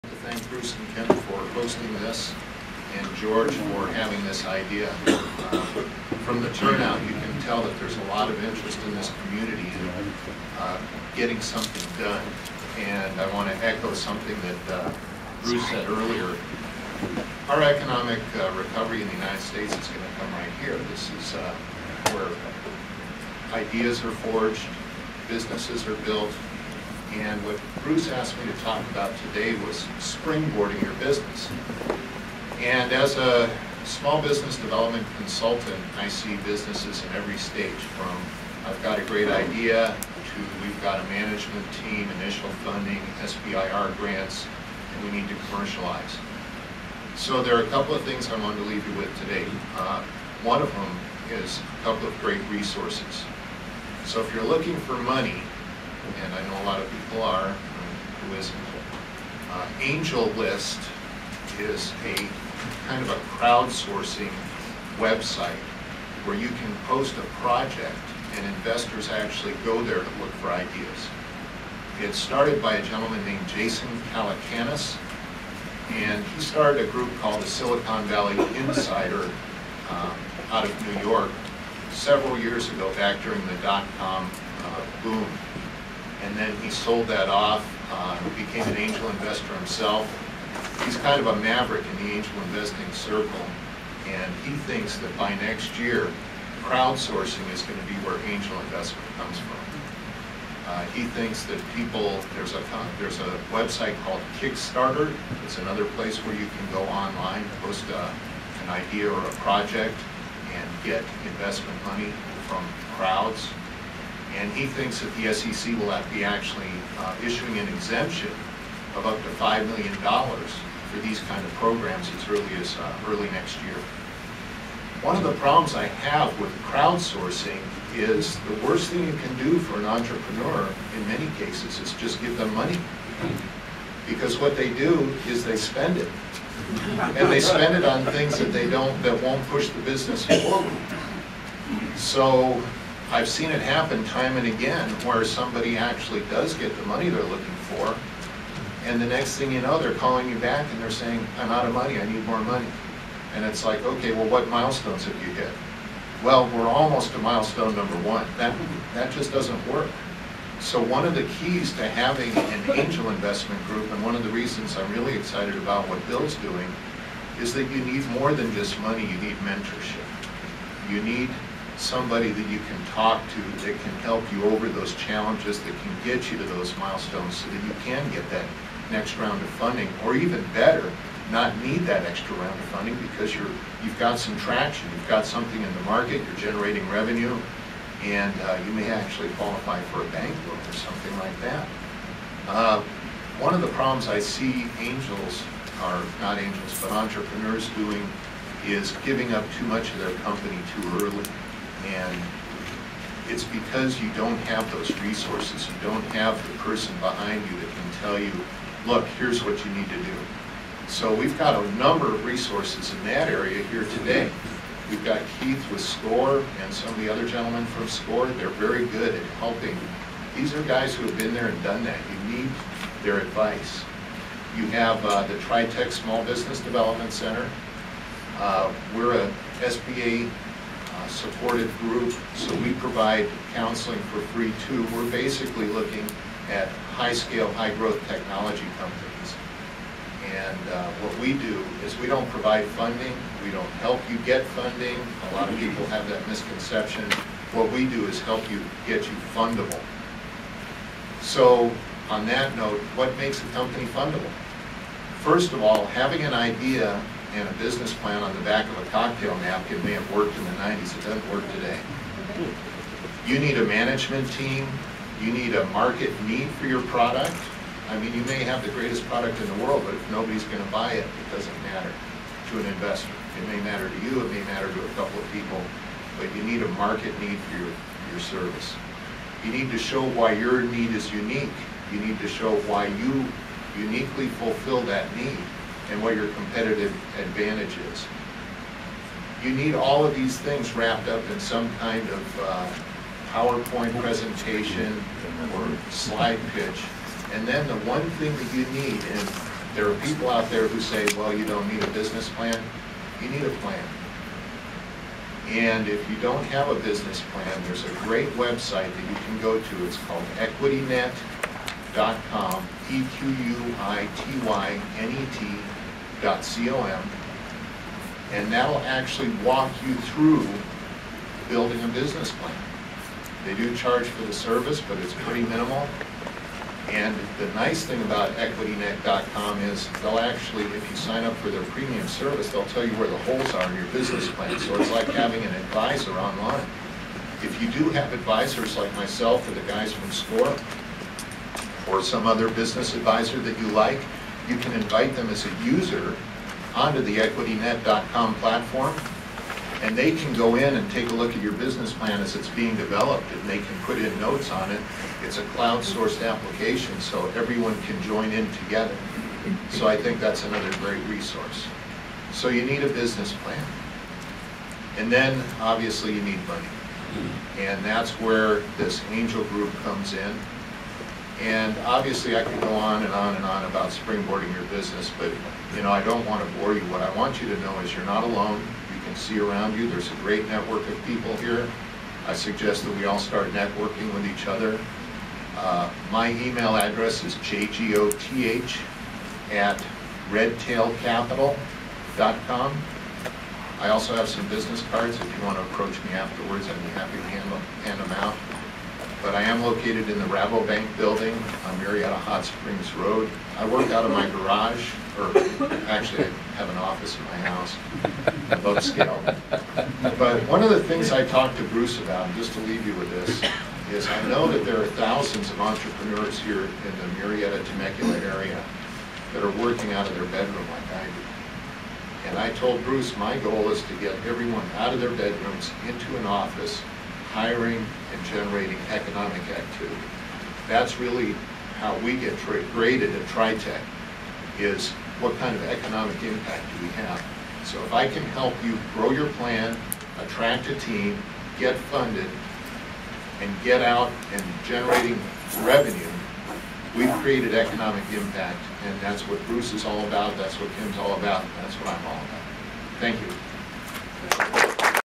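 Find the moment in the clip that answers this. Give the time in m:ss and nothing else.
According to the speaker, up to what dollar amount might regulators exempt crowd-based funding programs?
1:59.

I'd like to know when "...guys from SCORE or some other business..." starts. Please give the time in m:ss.
5:39.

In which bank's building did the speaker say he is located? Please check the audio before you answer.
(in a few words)
Rabobank.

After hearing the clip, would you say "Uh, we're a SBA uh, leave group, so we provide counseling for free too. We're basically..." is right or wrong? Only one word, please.
wrong.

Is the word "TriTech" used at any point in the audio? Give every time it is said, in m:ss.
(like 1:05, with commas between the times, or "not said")
3:45, 7:13.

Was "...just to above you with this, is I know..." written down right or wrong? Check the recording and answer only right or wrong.
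wrong.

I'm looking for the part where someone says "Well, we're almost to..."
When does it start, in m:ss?
2:36.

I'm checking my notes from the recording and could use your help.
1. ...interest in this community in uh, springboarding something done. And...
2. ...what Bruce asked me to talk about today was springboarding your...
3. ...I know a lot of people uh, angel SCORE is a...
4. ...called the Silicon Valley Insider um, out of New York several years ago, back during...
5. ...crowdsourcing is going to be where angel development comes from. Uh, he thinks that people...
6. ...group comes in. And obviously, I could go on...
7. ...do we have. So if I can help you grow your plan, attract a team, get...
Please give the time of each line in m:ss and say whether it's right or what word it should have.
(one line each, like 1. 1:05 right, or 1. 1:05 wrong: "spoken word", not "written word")
1. 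0:08 wrong: "getting", not "springboarding"
2. 0:27 right
3. 0:56 wrong: "List", not "SCORE"
4. 1:17 right
5. 1:36 wrong: "investment", not "development"
6. 6:09 right
7. 7:16 right.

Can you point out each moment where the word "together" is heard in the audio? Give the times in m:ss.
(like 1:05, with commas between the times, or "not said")
5:58.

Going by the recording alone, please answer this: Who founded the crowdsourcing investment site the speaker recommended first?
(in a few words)
Jason Calacanis.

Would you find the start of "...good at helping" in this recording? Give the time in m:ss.
3:38.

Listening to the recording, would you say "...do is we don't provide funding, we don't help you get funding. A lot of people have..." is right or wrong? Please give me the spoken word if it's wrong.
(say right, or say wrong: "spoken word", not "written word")
right.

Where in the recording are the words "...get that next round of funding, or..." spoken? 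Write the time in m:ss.
2:58.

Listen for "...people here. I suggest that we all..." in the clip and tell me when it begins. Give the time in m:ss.
6:21.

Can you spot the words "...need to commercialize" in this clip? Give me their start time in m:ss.
0:45.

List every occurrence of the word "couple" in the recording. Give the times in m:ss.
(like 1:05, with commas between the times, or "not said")
0:47, 0:51, 4:34.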